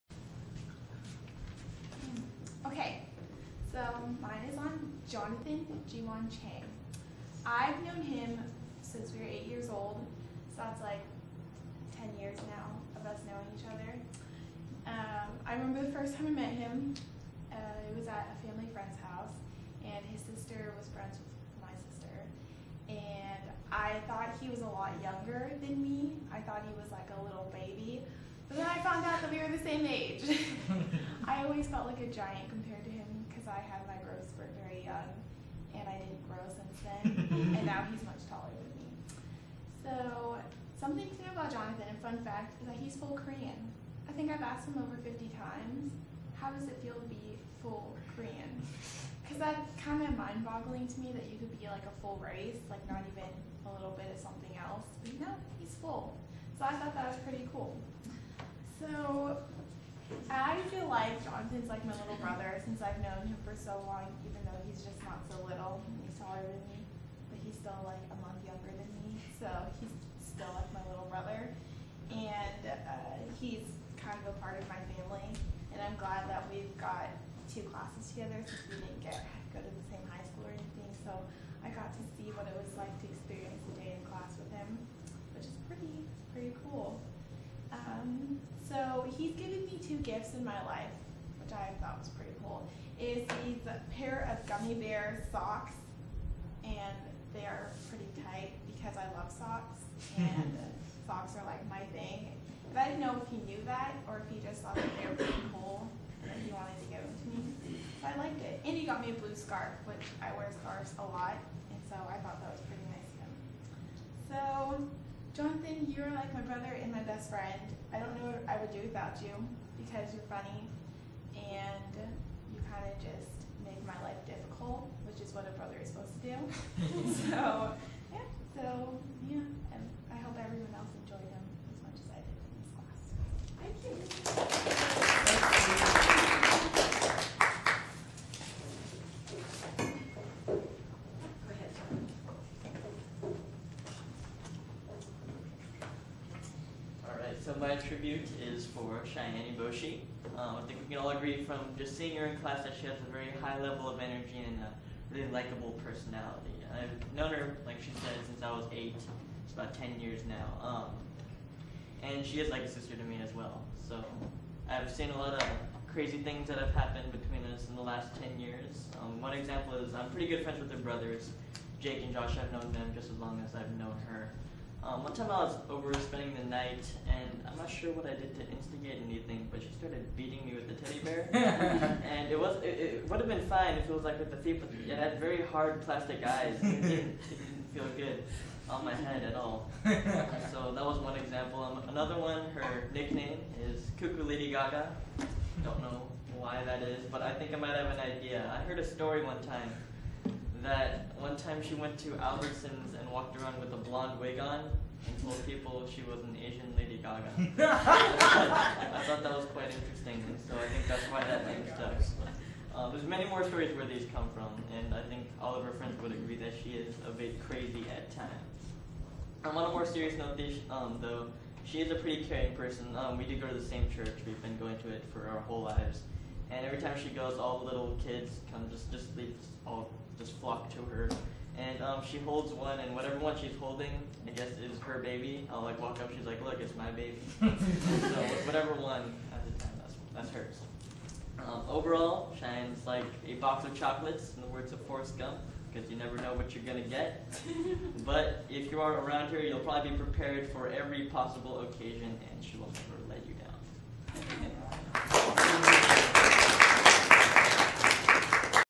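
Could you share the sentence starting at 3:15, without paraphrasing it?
Don't know why that is, but I think I might have an idea.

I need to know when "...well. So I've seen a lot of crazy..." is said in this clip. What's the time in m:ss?
2:43.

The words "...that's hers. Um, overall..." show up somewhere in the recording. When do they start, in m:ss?
4:00.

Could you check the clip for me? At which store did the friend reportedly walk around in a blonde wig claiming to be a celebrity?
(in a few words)
Albertsons.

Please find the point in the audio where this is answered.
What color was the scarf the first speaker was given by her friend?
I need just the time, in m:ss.
1:49.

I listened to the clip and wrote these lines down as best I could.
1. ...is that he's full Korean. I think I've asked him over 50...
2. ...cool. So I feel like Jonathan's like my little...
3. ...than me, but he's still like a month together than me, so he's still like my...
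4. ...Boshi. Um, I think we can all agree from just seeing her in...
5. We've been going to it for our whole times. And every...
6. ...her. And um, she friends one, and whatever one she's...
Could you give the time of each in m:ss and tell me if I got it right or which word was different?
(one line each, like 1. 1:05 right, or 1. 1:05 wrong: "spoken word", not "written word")
1. 0:42 right
2. 0:57 right
3. 1:06 wrong: "younger", not "together"
4. 2:29 right
5. 3:44 wrong: "lives", not "times"
6. 3:50 wrong: "holds", not "friends".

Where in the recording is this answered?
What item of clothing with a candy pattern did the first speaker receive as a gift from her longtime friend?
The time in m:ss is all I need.
1:34.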